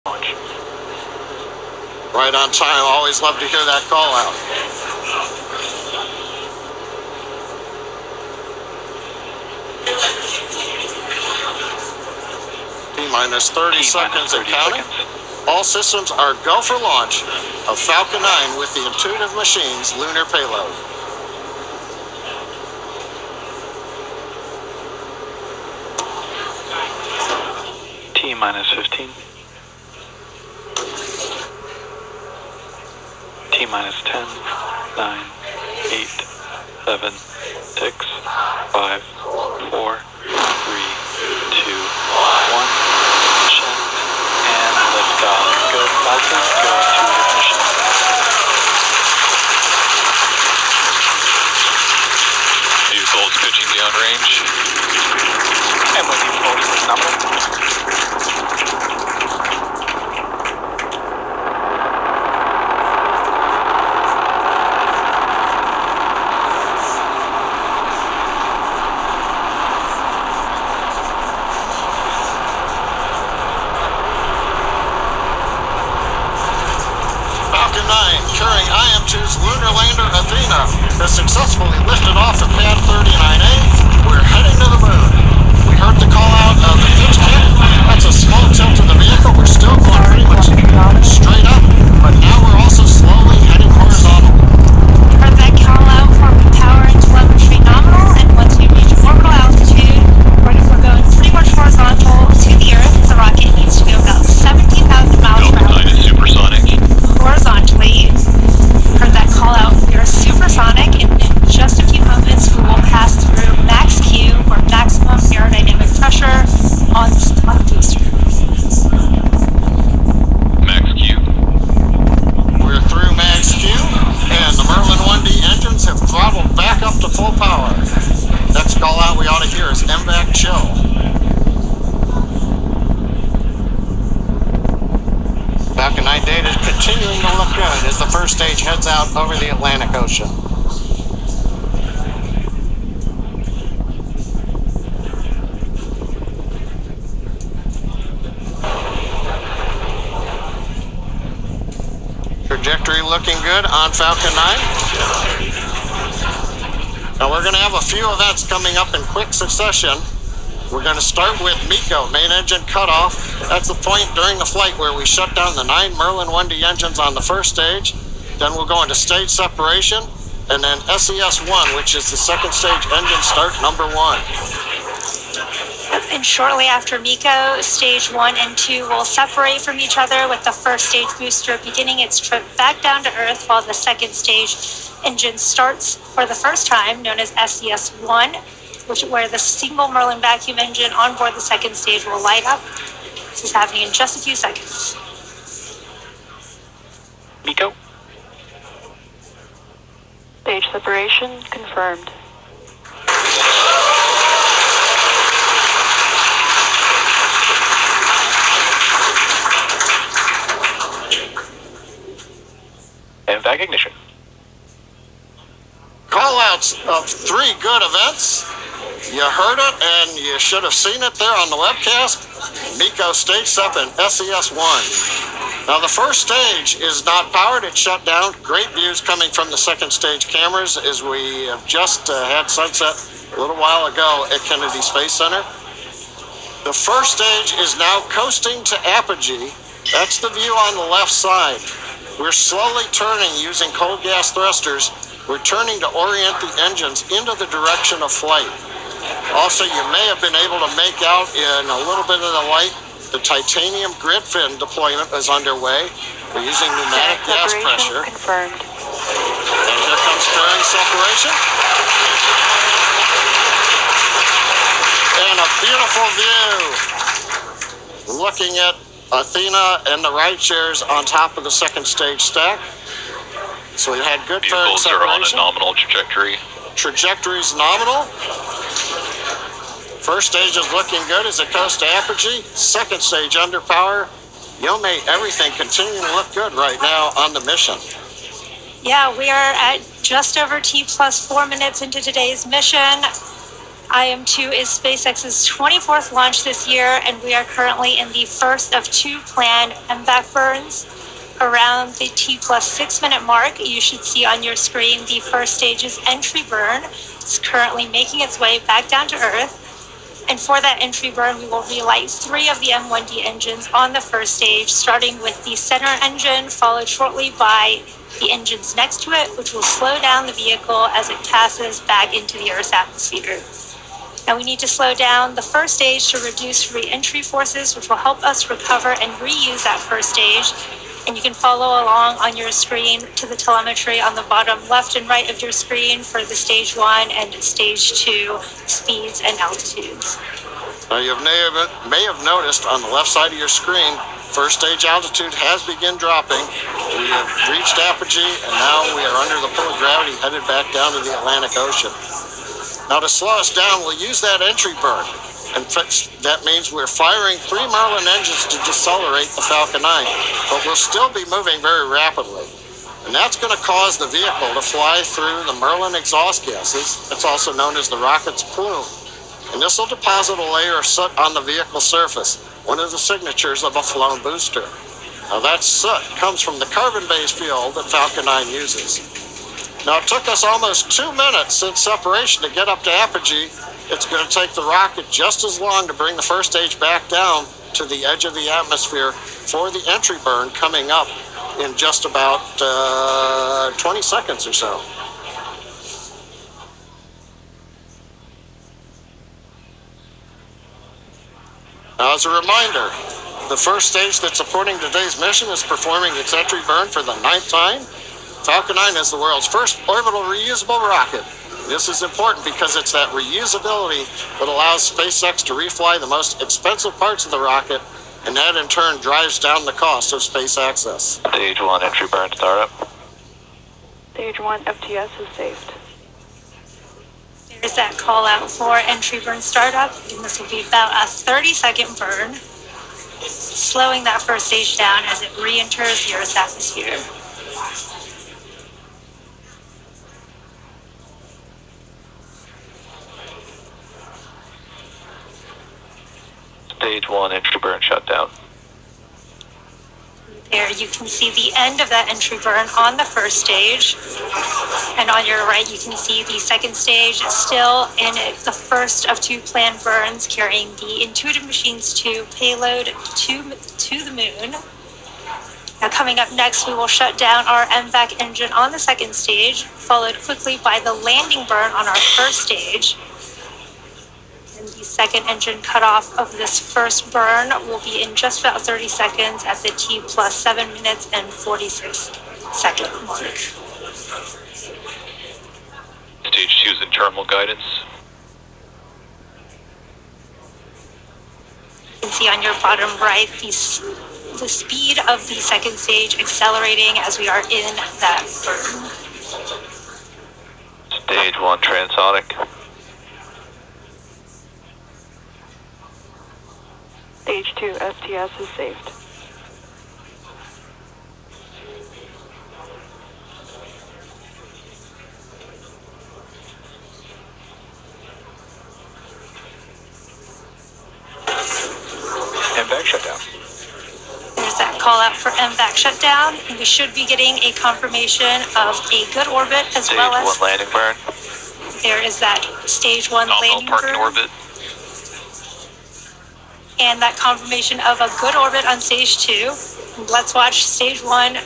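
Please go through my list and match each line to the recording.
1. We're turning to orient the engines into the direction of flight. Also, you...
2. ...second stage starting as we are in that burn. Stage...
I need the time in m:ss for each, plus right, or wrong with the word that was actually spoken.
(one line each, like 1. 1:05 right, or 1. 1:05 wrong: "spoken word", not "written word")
1. 4:05 right
2. 8:15 wrong: "accelerating", not "starting".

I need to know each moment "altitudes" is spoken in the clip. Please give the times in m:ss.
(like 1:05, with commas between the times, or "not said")
5:39, 5:44.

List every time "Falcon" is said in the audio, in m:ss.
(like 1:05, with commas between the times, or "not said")
0:17, 0:46, 2:33, 5:59, 6:17, 6:48.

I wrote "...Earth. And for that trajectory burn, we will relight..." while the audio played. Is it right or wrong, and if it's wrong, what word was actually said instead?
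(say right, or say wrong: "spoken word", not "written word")
wrong: "entry", not "trajectory".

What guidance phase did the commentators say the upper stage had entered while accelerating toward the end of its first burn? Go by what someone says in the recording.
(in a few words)
terminal guidance.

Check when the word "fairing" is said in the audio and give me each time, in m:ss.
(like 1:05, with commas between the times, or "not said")
4:20.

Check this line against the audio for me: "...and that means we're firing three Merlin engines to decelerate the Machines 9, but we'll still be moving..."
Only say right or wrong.
wrong.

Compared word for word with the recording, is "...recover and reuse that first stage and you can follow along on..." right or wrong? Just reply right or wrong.
right.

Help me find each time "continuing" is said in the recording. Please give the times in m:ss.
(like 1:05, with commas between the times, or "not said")
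2:16, 4:45.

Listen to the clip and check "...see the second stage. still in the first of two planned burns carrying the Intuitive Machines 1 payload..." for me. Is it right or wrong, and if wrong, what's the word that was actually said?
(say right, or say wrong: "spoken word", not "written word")
wrong: "2", not "1".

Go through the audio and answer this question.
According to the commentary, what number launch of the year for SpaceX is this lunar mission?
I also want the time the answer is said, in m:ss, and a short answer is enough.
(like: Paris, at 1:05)
24th, at 4:55.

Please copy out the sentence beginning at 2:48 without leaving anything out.
Then we'll go into stage separation and then SES 1, which is the second stage engine start number one.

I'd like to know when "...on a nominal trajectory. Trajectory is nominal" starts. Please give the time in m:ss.
4:35.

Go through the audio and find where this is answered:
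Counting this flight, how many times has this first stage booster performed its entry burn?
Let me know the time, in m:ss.
6:47.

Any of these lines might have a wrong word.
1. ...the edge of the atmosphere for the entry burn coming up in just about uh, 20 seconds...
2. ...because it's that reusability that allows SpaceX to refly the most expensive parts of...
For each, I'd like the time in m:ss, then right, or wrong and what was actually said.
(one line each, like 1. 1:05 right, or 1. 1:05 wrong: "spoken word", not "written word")
1. 6:27 right
2. 6:52 right.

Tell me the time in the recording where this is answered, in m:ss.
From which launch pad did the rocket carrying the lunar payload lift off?
1:22.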